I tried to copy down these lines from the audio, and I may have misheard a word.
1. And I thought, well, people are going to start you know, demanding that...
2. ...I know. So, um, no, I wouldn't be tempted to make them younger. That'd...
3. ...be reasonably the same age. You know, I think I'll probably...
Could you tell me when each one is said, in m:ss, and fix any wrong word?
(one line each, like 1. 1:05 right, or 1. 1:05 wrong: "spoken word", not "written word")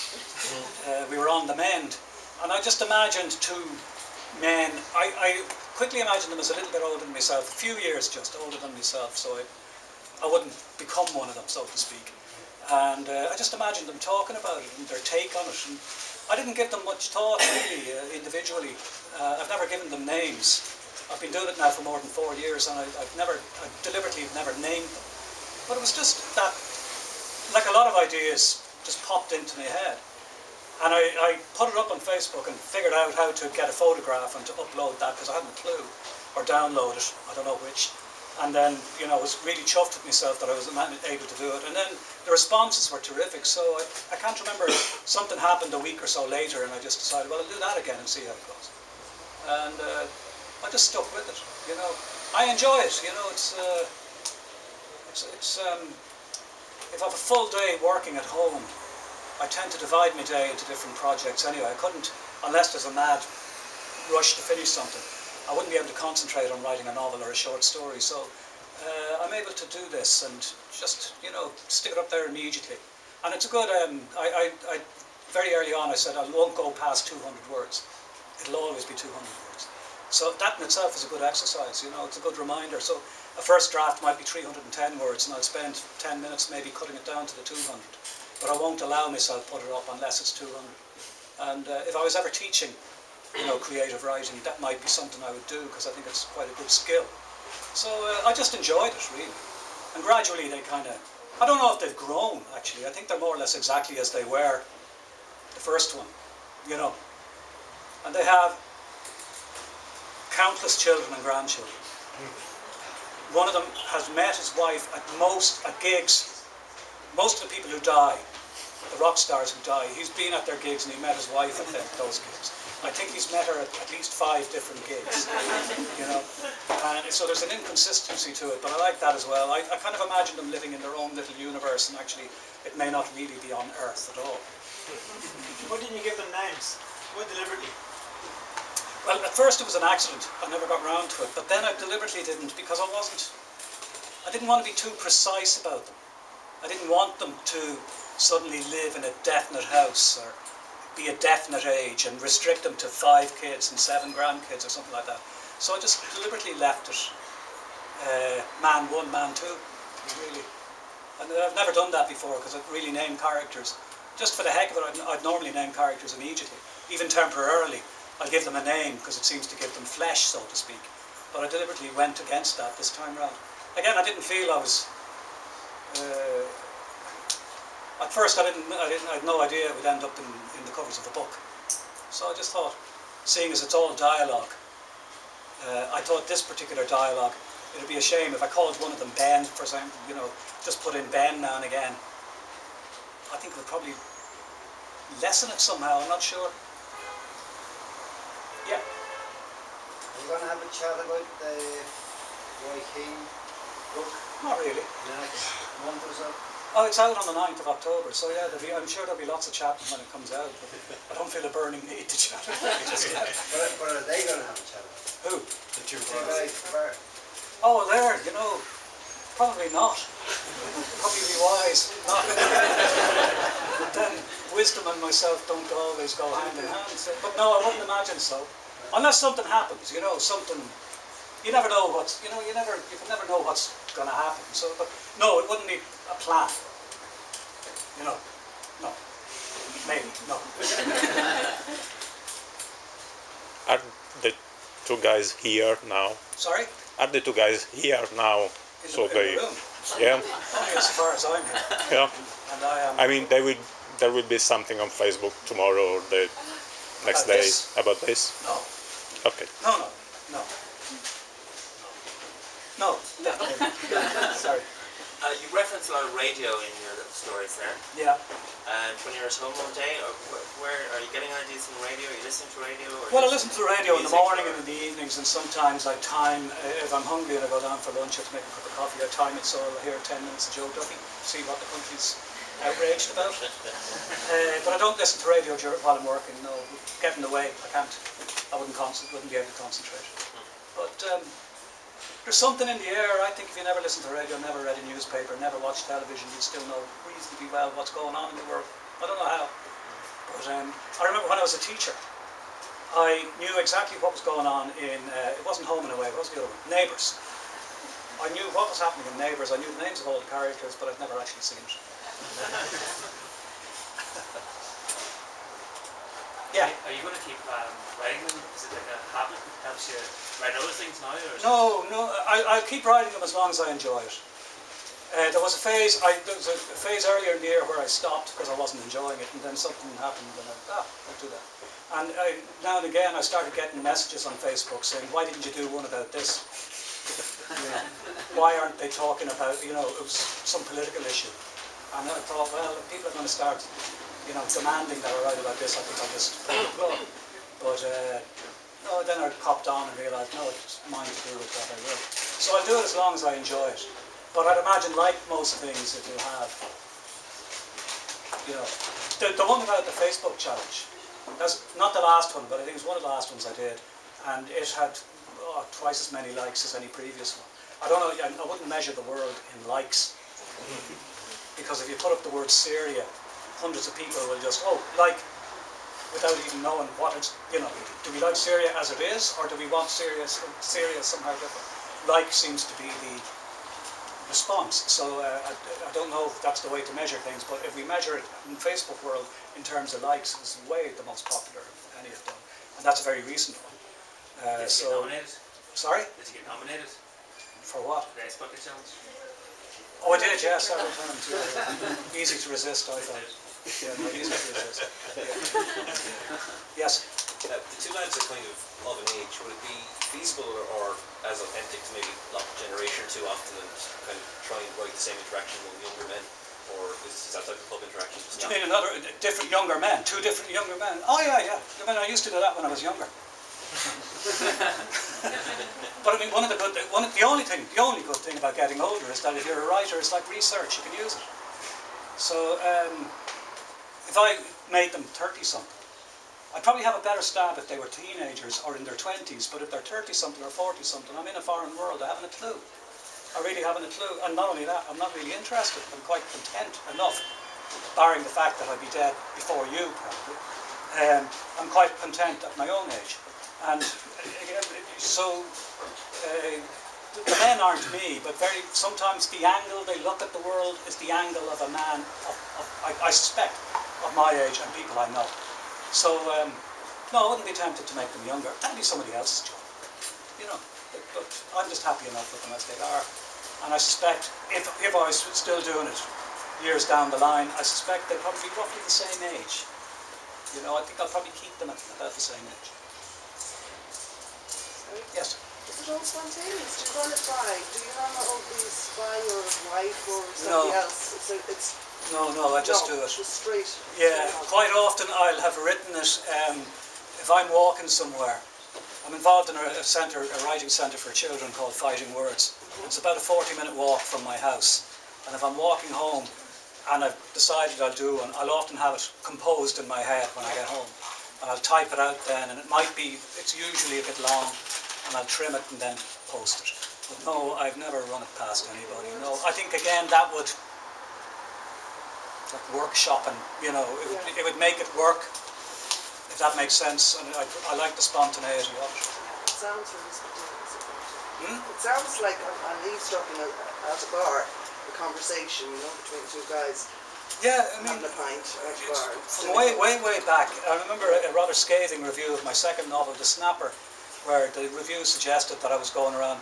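1. 5:41 right
2. 7:44 right
3. 7:58 wrong: "roughly", not "reasonably".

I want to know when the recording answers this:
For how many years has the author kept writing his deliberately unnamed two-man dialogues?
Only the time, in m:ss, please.
0:21.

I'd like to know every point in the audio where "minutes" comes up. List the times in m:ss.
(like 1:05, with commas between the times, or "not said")
1:26, 4:40, 8:23.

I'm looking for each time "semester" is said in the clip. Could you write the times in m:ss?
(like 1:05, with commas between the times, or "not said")
not said.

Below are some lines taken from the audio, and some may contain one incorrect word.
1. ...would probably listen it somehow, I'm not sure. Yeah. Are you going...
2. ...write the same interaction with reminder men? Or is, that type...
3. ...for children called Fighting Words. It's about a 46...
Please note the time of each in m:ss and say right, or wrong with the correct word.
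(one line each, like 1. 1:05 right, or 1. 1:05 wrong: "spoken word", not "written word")
1. 3:13 wrong: "lessen", not "listen"
2. 6:54 wrong: "younger", not "reminder"
3. 8:20 wrong: "40", not "46".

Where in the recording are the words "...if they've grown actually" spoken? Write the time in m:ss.
1:41.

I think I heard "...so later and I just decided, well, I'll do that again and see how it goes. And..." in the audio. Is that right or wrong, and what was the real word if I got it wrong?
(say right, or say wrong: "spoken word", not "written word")
right.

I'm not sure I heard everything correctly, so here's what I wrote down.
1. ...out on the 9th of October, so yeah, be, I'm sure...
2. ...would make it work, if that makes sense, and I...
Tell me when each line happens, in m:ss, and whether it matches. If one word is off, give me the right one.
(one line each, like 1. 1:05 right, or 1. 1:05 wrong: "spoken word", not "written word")
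1. 3:27 right
2. 8:44 right.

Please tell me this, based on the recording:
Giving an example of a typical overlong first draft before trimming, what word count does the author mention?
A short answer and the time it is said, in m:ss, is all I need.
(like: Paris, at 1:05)
310 words, at 1:24.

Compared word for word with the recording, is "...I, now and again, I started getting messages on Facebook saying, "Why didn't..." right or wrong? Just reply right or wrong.
right.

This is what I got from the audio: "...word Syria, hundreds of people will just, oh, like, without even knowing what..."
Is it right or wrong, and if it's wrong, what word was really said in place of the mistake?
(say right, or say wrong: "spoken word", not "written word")
right.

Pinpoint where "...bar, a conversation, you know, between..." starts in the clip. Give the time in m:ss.
8:54.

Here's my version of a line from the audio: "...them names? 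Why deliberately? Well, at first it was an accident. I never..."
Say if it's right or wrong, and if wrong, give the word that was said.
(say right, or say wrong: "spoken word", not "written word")
right.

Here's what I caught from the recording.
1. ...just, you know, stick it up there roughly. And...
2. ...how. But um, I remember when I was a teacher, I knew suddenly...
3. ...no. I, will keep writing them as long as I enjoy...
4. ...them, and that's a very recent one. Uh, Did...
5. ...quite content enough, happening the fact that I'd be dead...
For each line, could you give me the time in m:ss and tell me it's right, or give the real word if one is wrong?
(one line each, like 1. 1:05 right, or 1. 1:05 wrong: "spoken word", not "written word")
1. 1:10 wrong: "immediately", not "roughly"
2. 4:59 wrong: "exactly", not "suddenly"
3. 5:21 right
4. 6:32 right
5. 7:26 wrong: "barring", not "happening".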